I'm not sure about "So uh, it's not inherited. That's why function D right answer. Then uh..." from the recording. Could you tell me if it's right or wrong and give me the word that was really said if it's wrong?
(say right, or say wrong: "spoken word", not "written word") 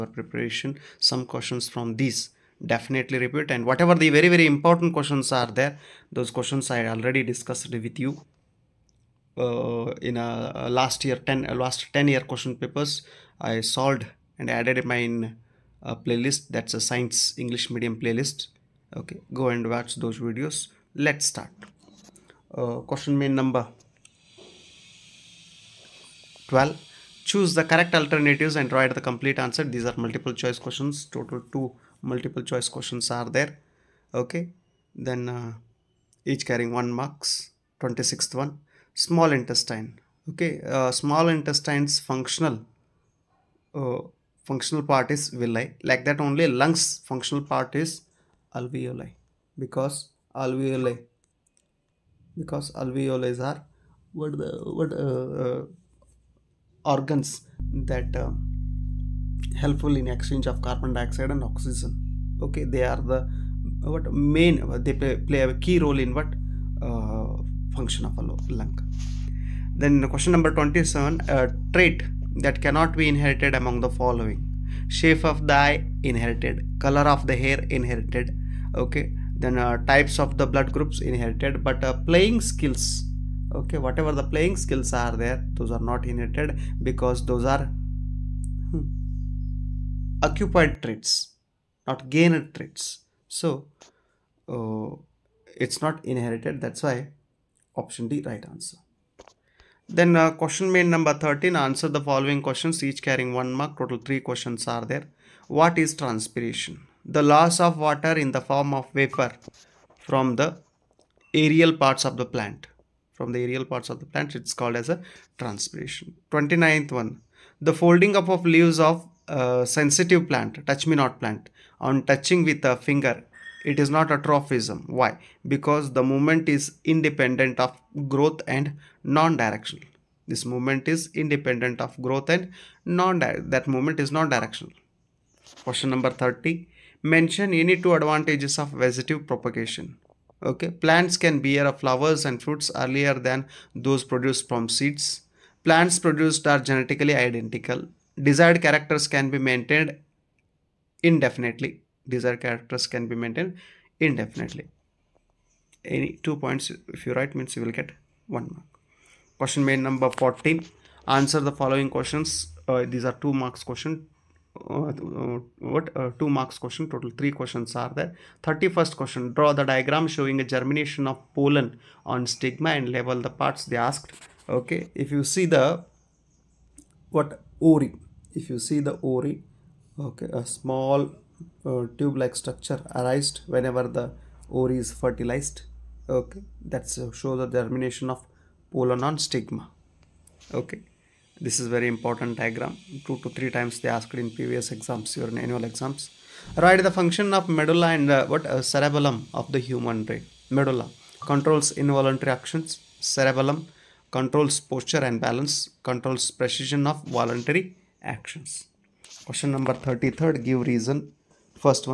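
wrong: "option", not "function".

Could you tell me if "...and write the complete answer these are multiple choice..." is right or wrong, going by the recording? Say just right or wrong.
right.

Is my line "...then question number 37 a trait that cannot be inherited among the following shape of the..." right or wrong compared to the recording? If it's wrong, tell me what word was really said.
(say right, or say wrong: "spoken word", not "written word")
wrong: "27", not "37".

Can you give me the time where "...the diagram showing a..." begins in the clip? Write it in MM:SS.
02:49.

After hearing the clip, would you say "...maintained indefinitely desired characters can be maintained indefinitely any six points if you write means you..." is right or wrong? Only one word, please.
wrong.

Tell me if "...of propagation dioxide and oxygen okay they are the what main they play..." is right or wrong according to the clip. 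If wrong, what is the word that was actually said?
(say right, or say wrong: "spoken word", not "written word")
wrong: "carbon", not "propagation".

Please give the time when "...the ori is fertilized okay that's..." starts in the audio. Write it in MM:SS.
03:03.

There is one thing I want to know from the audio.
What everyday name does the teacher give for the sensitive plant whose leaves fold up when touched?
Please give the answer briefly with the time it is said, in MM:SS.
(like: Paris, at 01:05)
Touch me not plant, at 02:00.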